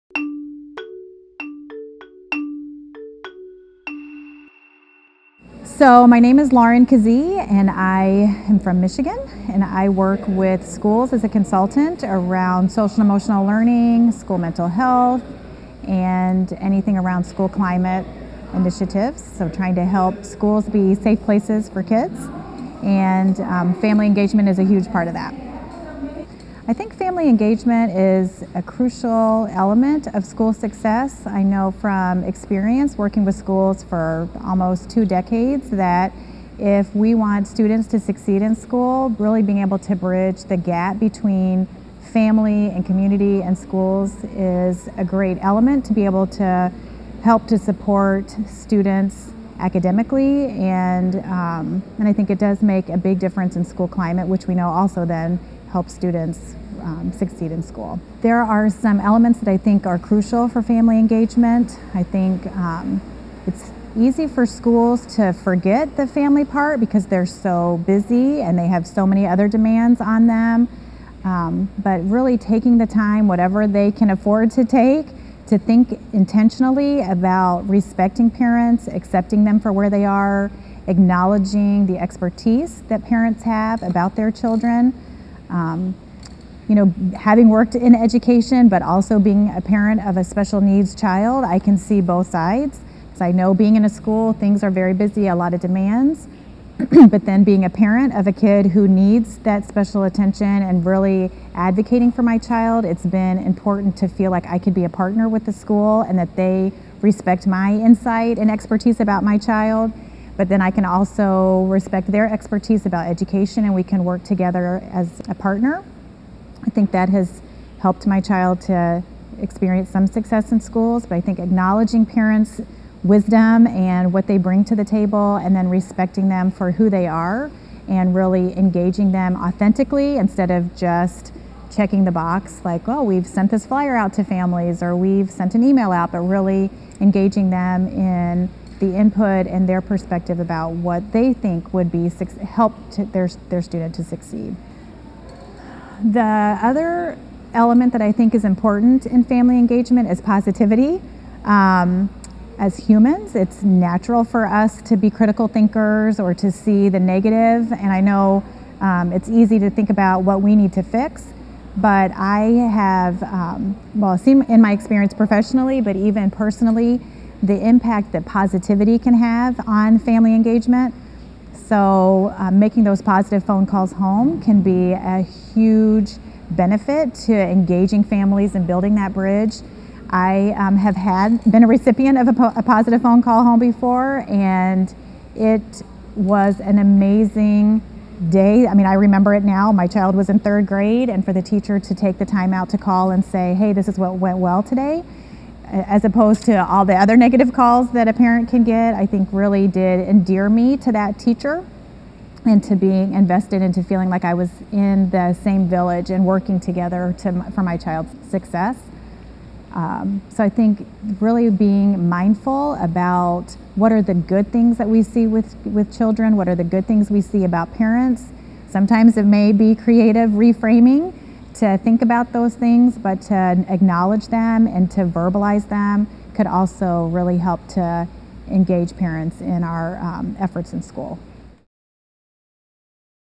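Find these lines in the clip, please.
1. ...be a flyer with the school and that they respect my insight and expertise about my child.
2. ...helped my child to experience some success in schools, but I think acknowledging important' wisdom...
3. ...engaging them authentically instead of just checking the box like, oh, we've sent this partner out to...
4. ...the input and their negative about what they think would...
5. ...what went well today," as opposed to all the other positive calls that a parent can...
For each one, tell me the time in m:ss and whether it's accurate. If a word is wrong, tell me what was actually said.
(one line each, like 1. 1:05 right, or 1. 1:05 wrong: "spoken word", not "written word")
1. 1:44 wrong: "partner", not "flyer"
2. 1:57 wrong: "parents", not "important"
3. 2:08 wrong: "flyer", not "partner"
4. 2:18 wrong: "perspective", not "negative"
5. 3:13 wrong: "negative", not "positive".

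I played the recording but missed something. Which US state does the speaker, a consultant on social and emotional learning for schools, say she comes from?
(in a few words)
Michigan.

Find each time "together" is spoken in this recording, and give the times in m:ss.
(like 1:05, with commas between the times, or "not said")
1:54, 3:26.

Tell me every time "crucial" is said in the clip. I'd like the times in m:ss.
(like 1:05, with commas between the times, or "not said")
0:28, 0:59.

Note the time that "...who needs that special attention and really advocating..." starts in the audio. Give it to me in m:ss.
1:38.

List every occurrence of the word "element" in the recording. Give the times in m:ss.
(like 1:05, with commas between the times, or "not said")
0:29, 0:45, 0:58, 2:27.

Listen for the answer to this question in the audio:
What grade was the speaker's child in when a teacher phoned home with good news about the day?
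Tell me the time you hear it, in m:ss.
3:10.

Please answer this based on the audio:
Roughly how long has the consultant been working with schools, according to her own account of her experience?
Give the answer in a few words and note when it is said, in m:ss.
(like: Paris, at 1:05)
almost two decades, at 0:34.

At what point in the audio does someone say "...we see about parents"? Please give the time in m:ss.
3:37.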